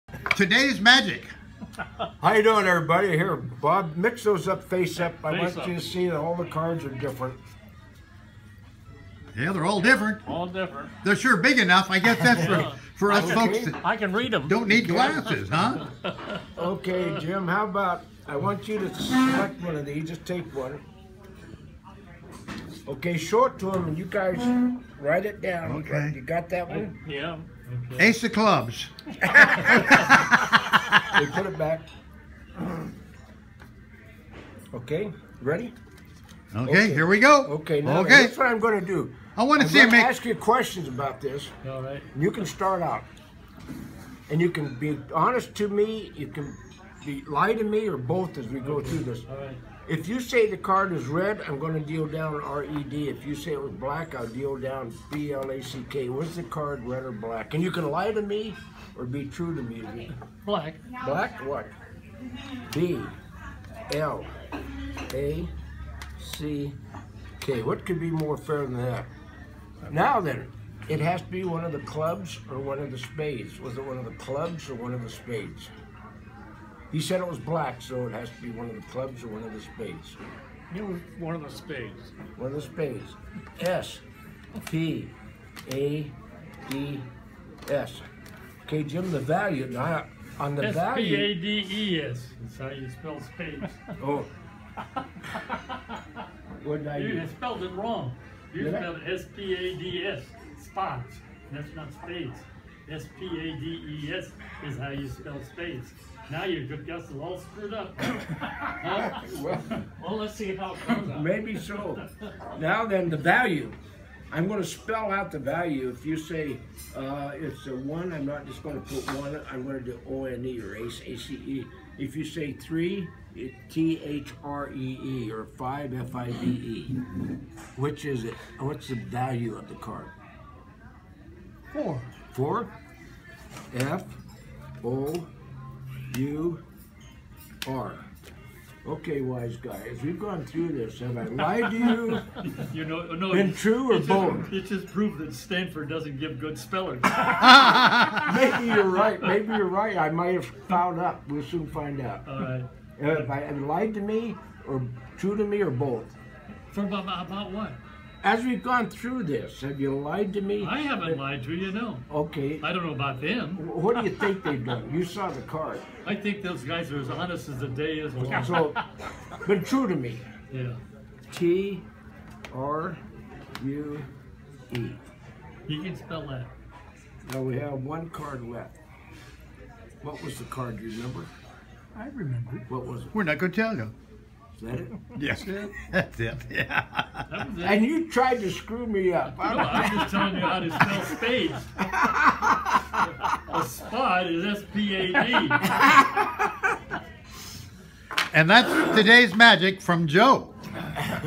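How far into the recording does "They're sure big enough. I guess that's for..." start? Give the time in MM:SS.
00:11.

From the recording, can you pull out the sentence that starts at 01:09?
Now then, it has to be one of the clubs or one of the spades.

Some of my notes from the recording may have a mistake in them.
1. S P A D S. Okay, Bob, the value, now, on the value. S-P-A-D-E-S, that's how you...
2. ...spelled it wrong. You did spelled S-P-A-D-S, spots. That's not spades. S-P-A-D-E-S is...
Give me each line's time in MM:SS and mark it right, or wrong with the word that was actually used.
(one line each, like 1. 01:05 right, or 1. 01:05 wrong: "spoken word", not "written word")
1. 01:23 wrong: "Jim", not "Bob"
2. 01:37 right.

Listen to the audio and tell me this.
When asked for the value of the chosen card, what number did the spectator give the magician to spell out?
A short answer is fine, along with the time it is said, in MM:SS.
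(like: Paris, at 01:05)
4, at 02:11.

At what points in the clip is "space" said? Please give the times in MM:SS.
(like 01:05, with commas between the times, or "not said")
01:45.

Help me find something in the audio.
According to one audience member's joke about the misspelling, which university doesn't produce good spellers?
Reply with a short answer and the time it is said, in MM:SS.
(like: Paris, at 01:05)
Stanford, at 02:25.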